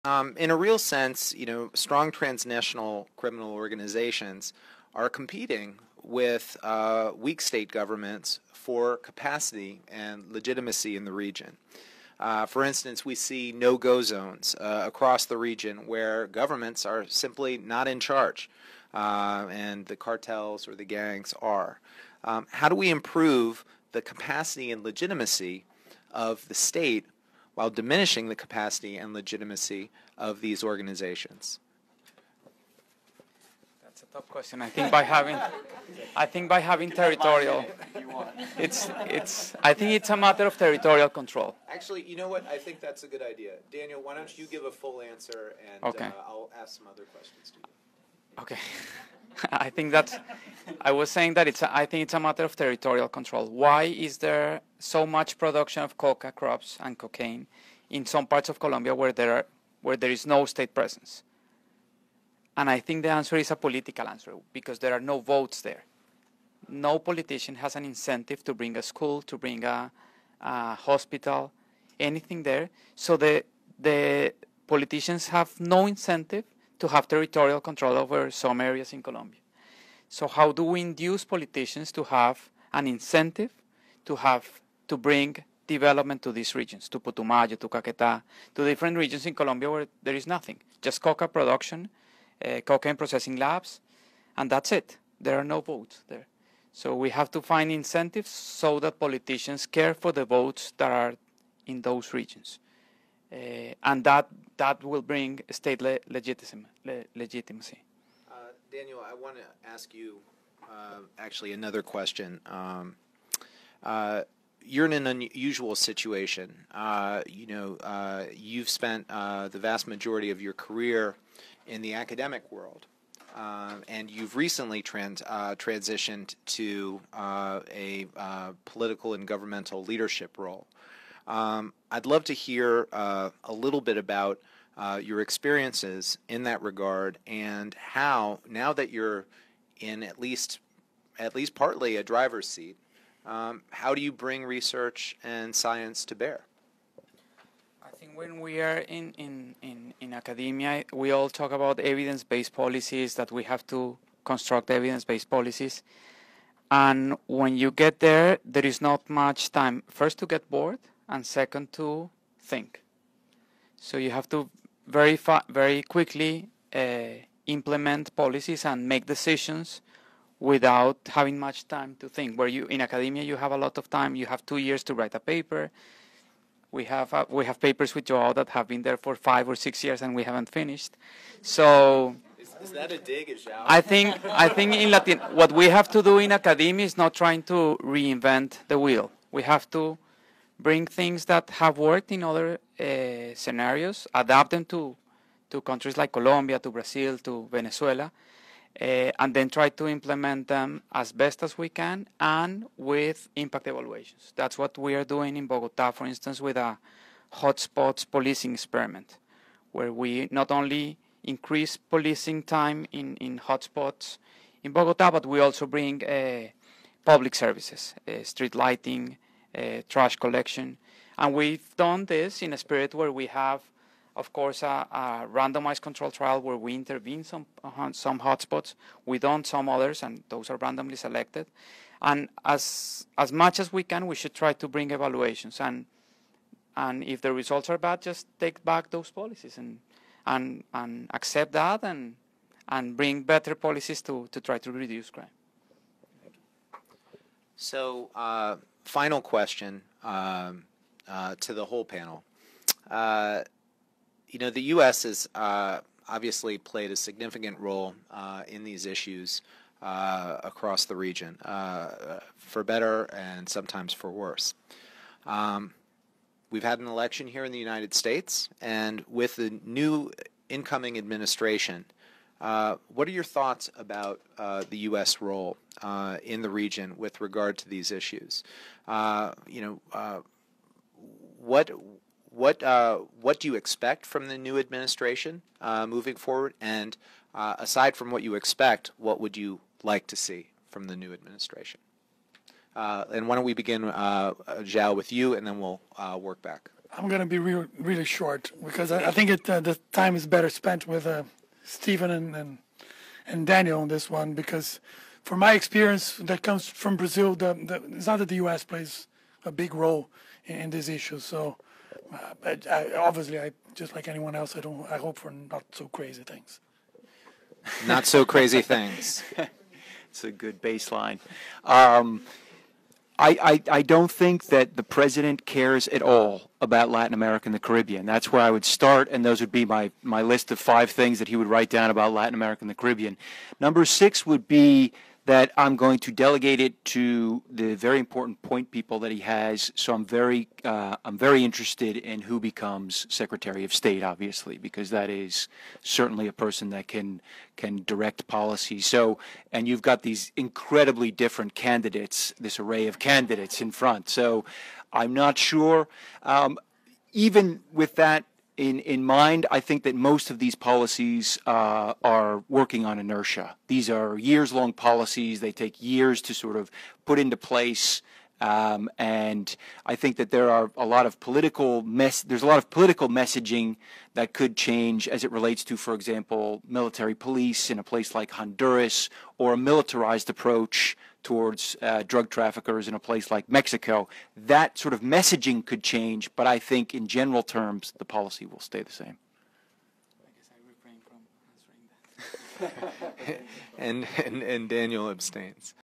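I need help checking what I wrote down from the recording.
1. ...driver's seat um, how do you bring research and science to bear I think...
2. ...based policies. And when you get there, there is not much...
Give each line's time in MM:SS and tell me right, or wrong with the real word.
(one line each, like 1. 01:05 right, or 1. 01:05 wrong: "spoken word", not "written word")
1. 02:22 right
2. 02:35 right.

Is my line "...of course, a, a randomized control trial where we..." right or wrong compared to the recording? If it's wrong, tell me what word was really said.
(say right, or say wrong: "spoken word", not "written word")
right.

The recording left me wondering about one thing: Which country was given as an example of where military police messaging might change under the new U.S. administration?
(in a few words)
Honduras.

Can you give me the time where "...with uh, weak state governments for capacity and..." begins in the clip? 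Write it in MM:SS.
00:06.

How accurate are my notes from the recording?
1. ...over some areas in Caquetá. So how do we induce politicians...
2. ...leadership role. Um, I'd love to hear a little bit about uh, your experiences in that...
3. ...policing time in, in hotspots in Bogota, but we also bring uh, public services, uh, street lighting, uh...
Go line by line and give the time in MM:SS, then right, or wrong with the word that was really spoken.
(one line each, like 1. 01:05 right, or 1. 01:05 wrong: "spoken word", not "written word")
1. 01:17 wrong: "Colombia", not "Caquetá"
2. 02:09 right
3. 03:31 right.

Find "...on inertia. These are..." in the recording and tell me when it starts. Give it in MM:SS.
06:02.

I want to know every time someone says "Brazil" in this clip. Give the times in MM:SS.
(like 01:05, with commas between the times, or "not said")
03:16, 05:06.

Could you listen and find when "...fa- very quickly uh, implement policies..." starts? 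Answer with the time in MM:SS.
02:45.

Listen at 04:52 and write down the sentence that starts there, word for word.
Uh, and why don't we begin, uh, uh, Joao, with you, and then we'll uh, work back.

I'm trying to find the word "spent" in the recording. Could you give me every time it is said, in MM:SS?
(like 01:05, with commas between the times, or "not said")
01:58, 05:00.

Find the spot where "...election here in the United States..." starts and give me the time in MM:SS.
04:26.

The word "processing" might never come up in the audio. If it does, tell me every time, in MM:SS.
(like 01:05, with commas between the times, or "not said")
01:32.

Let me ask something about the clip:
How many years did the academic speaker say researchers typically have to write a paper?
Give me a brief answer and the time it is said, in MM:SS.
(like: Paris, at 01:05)
2 years, at 02:54.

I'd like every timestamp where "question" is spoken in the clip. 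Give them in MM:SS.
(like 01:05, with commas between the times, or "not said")
00:34, 00:47, 01:51, 04:09.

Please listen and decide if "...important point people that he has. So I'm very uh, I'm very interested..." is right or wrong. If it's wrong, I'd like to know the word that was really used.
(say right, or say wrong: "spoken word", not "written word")
right.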